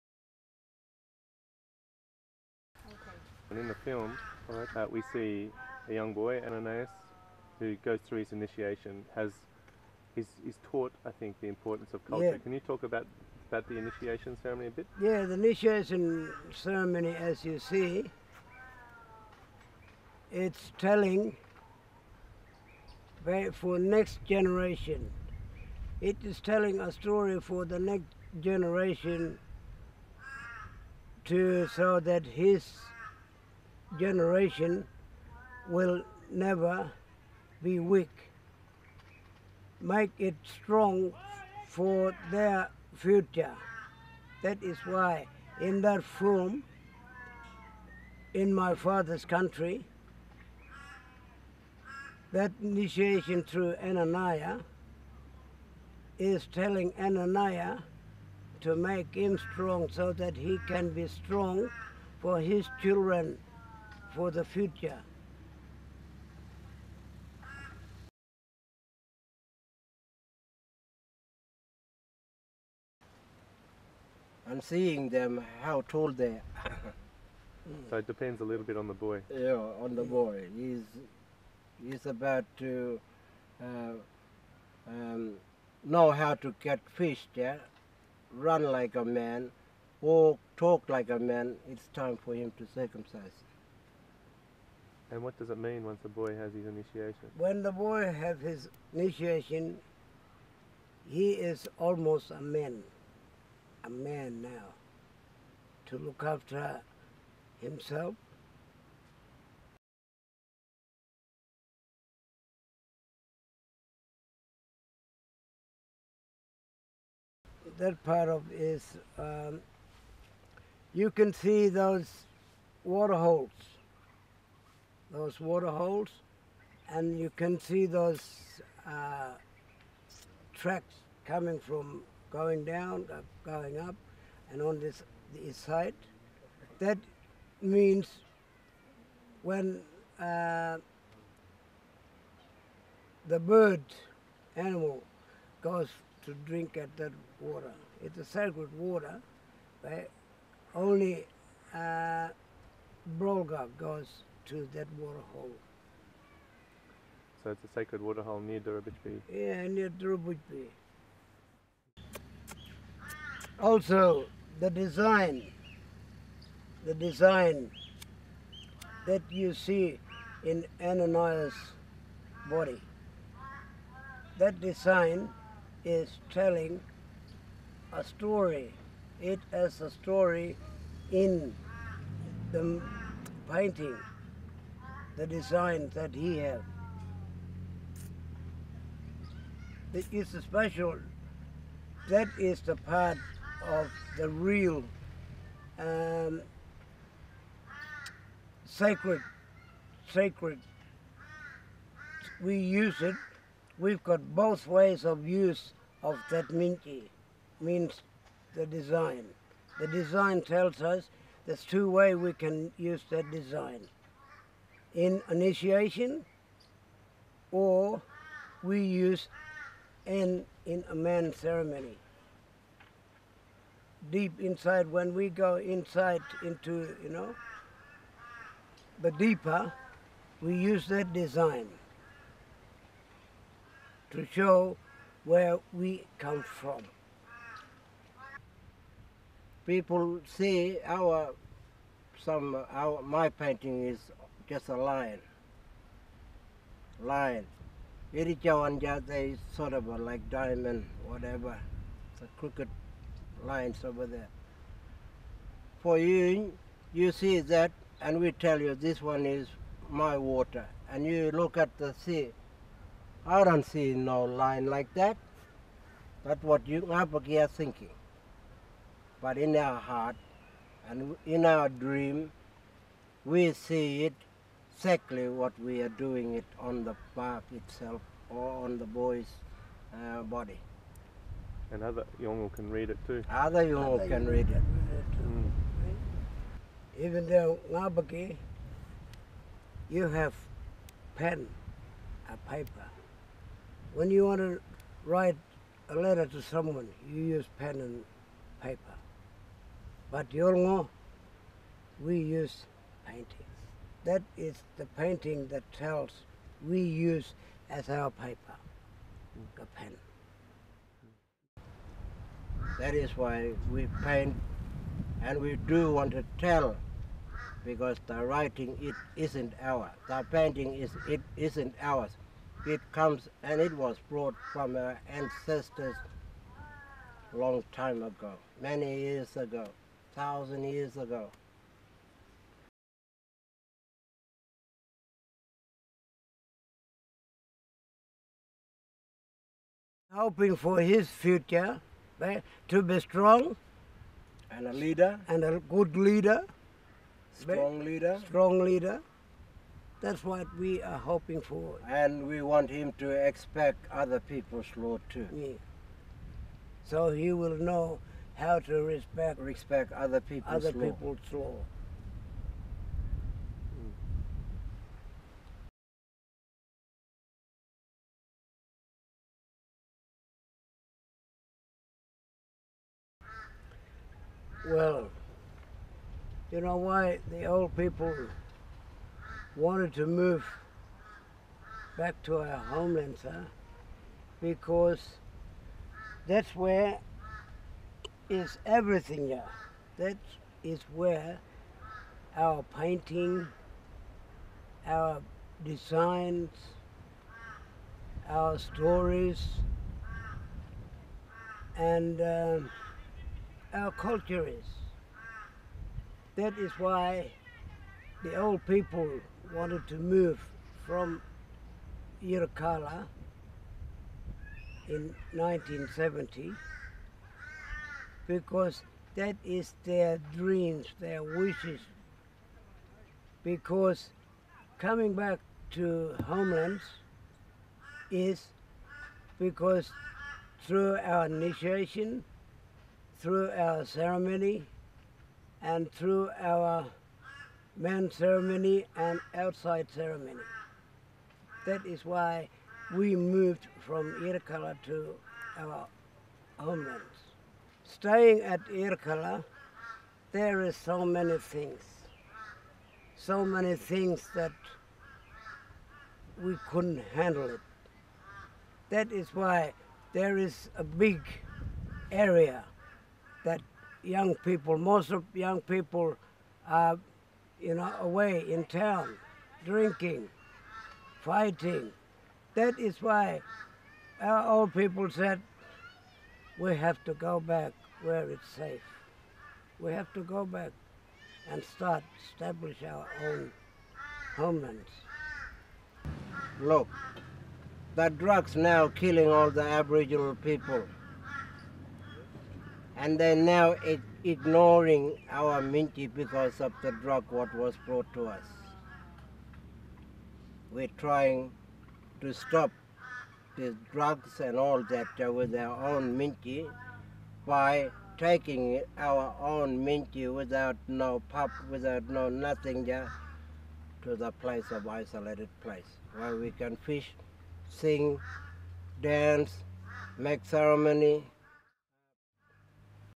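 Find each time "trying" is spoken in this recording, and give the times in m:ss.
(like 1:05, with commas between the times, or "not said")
8:20.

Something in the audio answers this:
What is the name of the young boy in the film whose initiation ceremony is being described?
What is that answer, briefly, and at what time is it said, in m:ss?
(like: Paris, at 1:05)
Ananias, at 0:06.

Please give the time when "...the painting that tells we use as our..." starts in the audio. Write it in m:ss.
5:04.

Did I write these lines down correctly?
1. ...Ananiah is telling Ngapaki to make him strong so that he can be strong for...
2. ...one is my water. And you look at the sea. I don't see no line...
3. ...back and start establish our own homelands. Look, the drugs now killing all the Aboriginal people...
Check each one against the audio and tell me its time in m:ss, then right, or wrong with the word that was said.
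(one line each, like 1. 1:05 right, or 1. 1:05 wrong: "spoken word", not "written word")
1. 0:53 wrong: "Ananiah", not "Ngapaki"
2. 4:19 right
3. 8:00 right.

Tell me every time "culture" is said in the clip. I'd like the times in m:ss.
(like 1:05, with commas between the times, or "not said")
0:12, 6:43.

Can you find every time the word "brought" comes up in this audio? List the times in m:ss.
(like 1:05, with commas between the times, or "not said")
5:24, 8:17.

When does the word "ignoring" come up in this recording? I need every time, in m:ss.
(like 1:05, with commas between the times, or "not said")
8:14.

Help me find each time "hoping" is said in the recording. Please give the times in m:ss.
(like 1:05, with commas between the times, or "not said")
5:40, 5:50.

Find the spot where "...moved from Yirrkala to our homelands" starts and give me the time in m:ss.
7:23.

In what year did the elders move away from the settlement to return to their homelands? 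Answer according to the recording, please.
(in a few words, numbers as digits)
1970.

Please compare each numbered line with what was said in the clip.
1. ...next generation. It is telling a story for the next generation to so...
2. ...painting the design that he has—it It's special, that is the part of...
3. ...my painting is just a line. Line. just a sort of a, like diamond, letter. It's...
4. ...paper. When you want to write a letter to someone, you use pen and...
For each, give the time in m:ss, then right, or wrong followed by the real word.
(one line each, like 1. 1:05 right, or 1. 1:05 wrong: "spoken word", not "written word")
1. 0:23 right
2. 3:03 right
3. 4:03 wrong: "whatever", not "letter"
4. 4:52 right.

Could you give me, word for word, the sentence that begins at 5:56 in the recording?
so he will know how to respect respect other people's other law.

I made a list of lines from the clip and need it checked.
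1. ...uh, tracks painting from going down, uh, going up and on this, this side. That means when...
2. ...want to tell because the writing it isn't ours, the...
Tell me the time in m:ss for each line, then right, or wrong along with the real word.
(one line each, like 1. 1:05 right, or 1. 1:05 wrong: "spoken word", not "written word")
1. 2:08 wrong: "coming", not "painting"
2. 5:15 right.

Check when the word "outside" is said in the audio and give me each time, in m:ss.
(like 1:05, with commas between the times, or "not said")
7:19.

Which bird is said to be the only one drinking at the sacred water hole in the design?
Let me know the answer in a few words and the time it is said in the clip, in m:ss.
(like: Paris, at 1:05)
Brolga, at 2:33.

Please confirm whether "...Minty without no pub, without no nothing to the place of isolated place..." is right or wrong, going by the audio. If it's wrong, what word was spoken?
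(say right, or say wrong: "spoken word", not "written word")
right.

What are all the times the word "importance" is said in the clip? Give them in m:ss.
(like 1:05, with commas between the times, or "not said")
0:11.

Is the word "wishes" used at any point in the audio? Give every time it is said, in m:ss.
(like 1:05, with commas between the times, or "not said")
7:01.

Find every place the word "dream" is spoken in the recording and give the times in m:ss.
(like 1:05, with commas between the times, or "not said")
4:31, 7:00.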